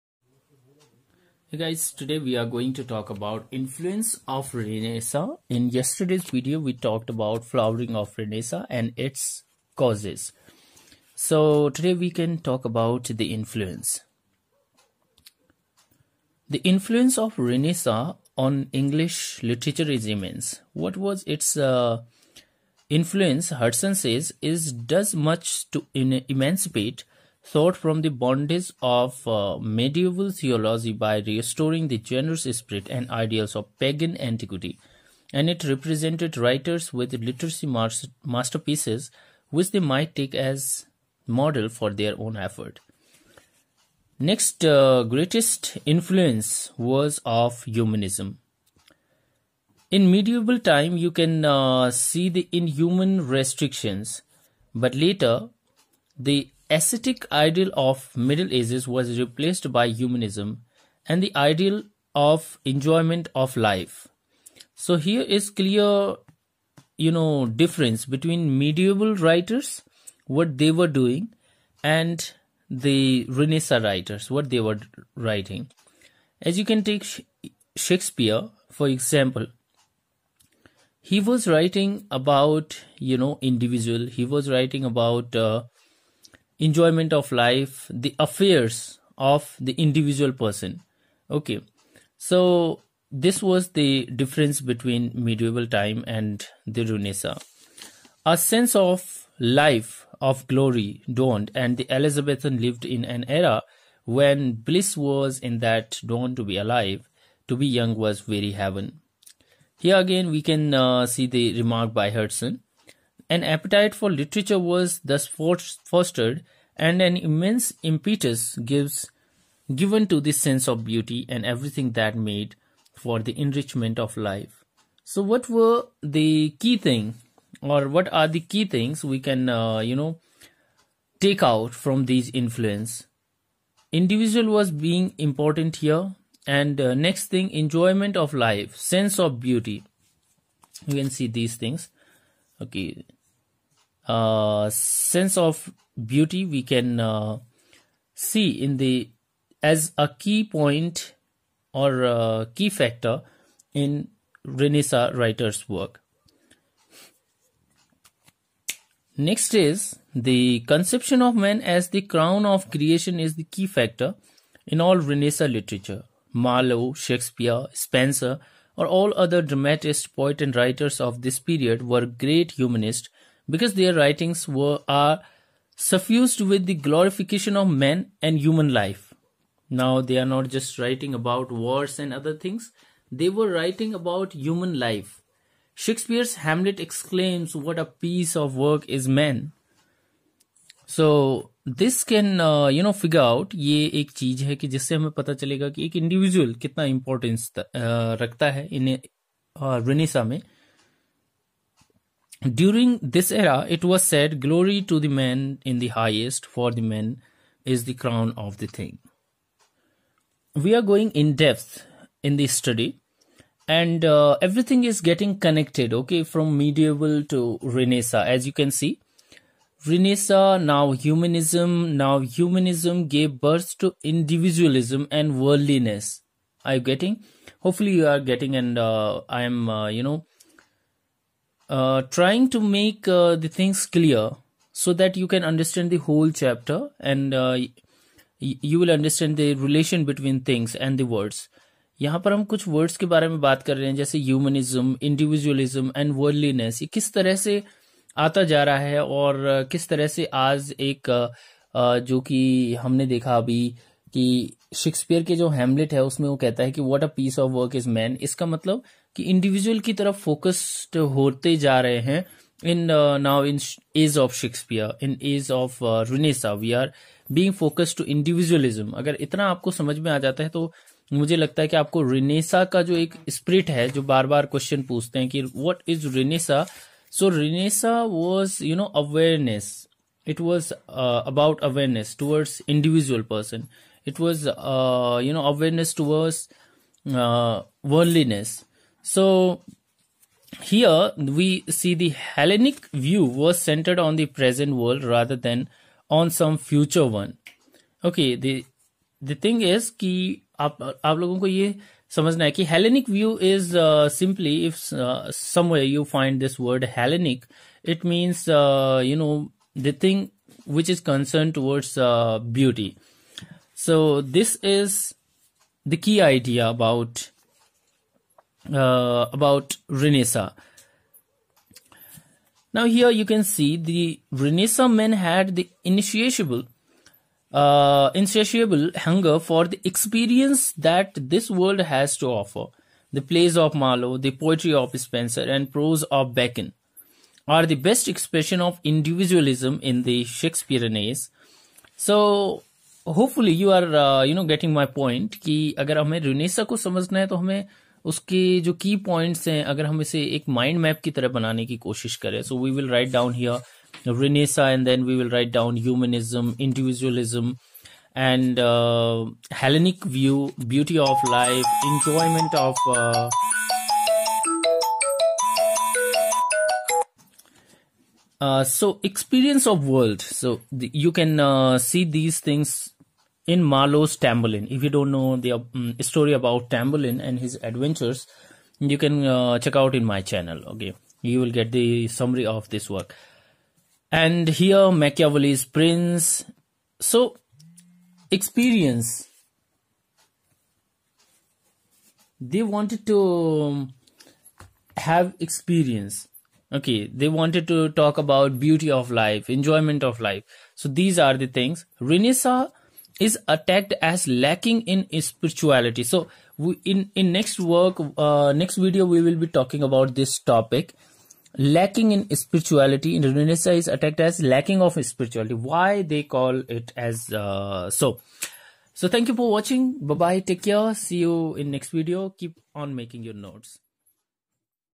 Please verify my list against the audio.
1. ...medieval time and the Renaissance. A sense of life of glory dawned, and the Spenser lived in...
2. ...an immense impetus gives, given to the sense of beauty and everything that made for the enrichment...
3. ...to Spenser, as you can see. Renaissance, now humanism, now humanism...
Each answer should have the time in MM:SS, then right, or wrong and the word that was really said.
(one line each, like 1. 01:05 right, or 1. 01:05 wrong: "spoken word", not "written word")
1. 01:35 wrong: "Elizabethan", not "Spenser"
2. 01:57 right
3. 03:37 wrong: "Renaissance", not "Spenser".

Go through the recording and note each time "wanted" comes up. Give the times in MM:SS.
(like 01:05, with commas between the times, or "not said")
06:32, 06:37.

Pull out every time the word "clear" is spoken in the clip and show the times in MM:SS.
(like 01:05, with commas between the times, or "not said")
01:05, 03:53.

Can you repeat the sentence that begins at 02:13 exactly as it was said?
Individual was being important here, and uh, next thing, enjoyment of life, sense of beauty.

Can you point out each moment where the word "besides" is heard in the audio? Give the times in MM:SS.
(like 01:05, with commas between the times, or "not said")
not said.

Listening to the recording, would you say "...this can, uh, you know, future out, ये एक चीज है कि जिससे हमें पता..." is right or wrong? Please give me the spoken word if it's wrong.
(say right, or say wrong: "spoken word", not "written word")
wrong: "figure", not "future".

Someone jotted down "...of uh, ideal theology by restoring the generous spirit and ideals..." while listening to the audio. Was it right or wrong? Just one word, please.
wrong.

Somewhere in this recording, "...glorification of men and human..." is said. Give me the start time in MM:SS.
02:56.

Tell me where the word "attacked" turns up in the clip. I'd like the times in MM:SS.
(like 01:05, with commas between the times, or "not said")
06:43, 06:53.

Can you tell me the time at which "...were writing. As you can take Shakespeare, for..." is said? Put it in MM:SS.
01:14.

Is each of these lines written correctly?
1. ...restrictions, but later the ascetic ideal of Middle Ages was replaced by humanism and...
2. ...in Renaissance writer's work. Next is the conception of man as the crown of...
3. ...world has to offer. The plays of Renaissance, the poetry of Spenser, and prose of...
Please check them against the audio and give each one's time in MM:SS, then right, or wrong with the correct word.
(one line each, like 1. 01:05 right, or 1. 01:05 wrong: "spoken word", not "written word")
1. 00:53 right
2. 02:33 right
3. 05:31 wrong: "Marlowe", not "Renaissance".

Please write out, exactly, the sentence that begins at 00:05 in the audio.
In yesterday's video, we talked about flowering of Renaissance and its causes.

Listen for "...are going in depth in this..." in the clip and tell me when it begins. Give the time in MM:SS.
03:30.